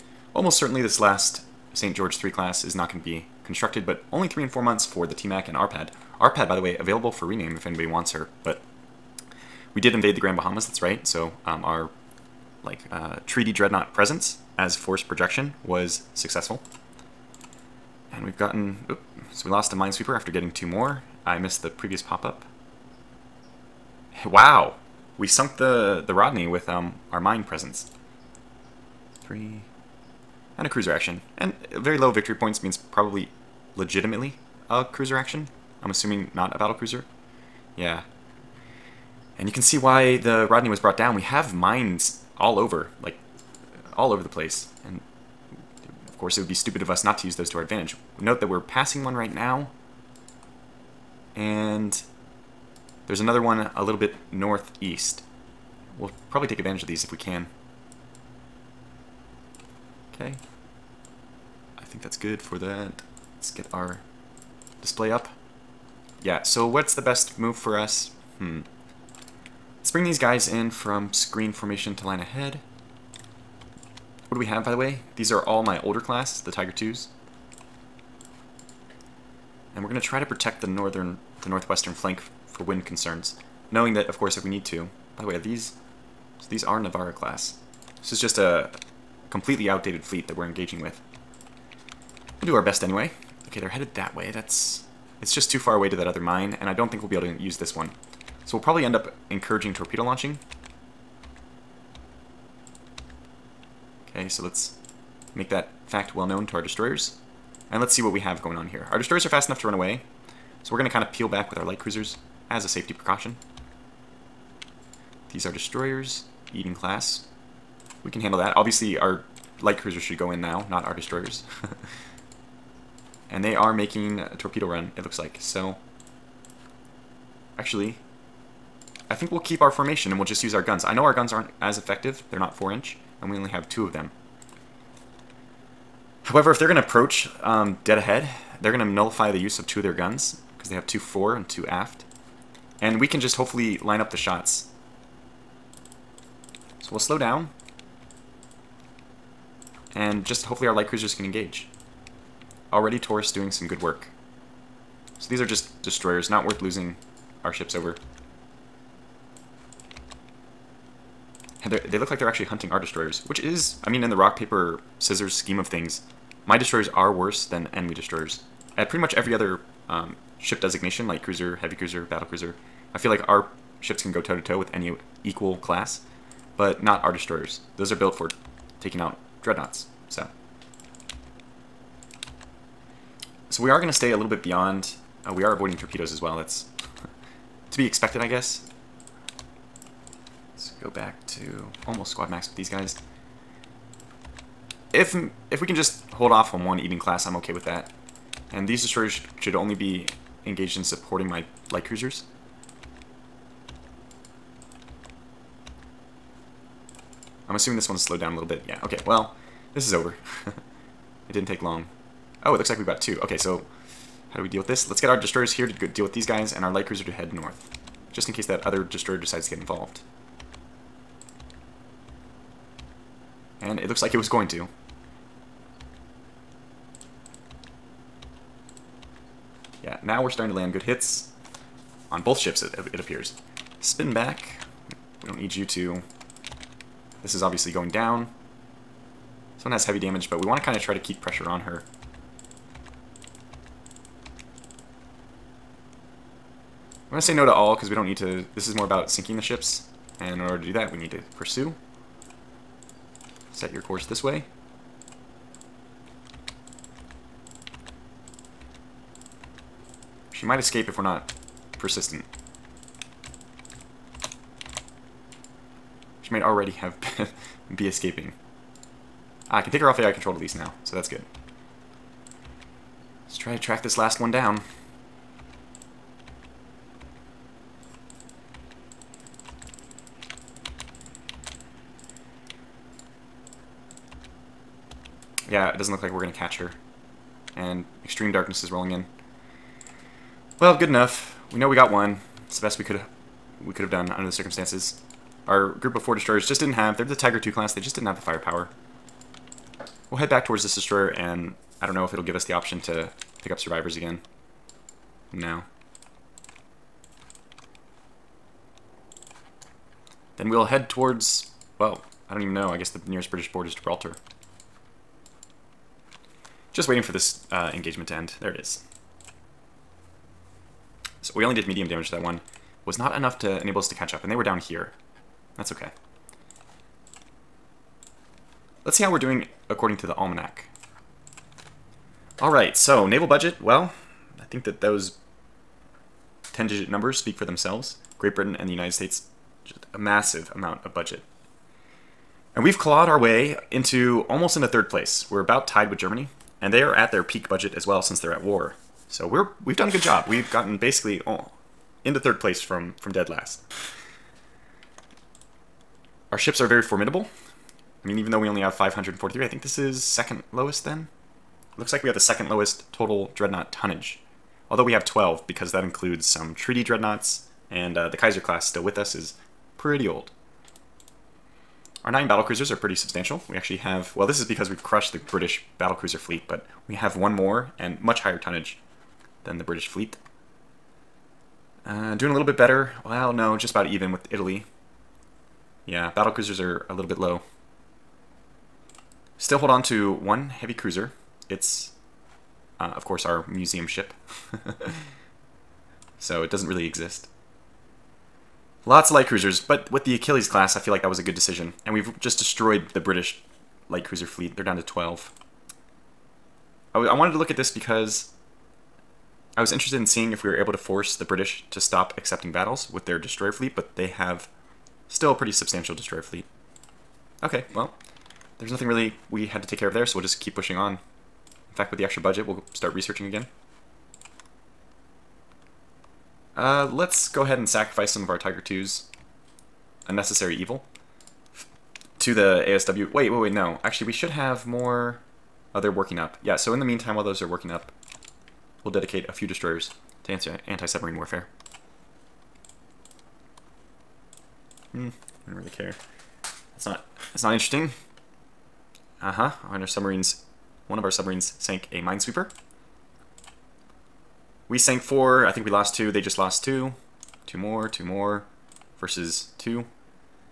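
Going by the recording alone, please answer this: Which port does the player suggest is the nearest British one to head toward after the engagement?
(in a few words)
Gibraltar.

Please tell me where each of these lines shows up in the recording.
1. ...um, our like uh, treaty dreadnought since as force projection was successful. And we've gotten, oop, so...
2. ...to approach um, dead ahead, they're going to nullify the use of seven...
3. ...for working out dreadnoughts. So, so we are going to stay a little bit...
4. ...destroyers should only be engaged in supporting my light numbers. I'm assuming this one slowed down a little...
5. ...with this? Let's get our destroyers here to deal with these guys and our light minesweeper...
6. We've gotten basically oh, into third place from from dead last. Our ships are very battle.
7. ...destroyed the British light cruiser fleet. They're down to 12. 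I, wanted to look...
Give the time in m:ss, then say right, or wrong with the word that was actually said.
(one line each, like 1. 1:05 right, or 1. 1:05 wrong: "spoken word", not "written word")
1. 0:11 wrong: "presence", not "since"
2. 2:16 wrong: "two", not "seven"
3. 2:58 wrong: "taking", not "working"
4. 3:18 wrong: "cruisers", not "numbers"
5. 3:34 wrong: "cruiser", not "minesweeper"
6. 5:50 wrong: "formidable", not "battle"
7. 6:42 right.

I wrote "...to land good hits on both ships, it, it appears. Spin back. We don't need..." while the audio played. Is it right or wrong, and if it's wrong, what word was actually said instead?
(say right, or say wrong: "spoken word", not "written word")
right.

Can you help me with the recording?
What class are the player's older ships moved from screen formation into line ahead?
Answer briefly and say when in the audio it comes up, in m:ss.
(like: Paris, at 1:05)
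Tiger 2, at 1:16.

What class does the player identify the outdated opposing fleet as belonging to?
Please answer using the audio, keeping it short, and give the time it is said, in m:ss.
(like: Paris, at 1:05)
Navarra, at 1:26.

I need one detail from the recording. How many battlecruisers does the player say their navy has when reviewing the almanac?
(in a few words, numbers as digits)
9.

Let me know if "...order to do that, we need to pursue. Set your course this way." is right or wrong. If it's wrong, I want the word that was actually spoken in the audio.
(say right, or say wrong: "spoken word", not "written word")
right.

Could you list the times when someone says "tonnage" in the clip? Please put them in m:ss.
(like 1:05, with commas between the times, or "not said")
6:03, 6:18.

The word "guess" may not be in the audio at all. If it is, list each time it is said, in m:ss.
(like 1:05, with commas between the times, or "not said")
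3:08, 5:12.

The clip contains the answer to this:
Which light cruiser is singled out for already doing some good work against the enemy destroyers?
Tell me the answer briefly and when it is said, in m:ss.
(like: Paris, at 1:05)
Taurus, at 2:32.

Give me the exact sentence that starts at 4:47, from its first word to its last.
And extreme darkness is rolling in.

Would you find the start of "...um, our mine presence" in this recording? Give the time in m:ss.
0:26.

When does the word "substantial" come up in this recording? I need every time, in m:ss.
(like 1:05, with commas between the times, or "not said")
6:12, 6:55.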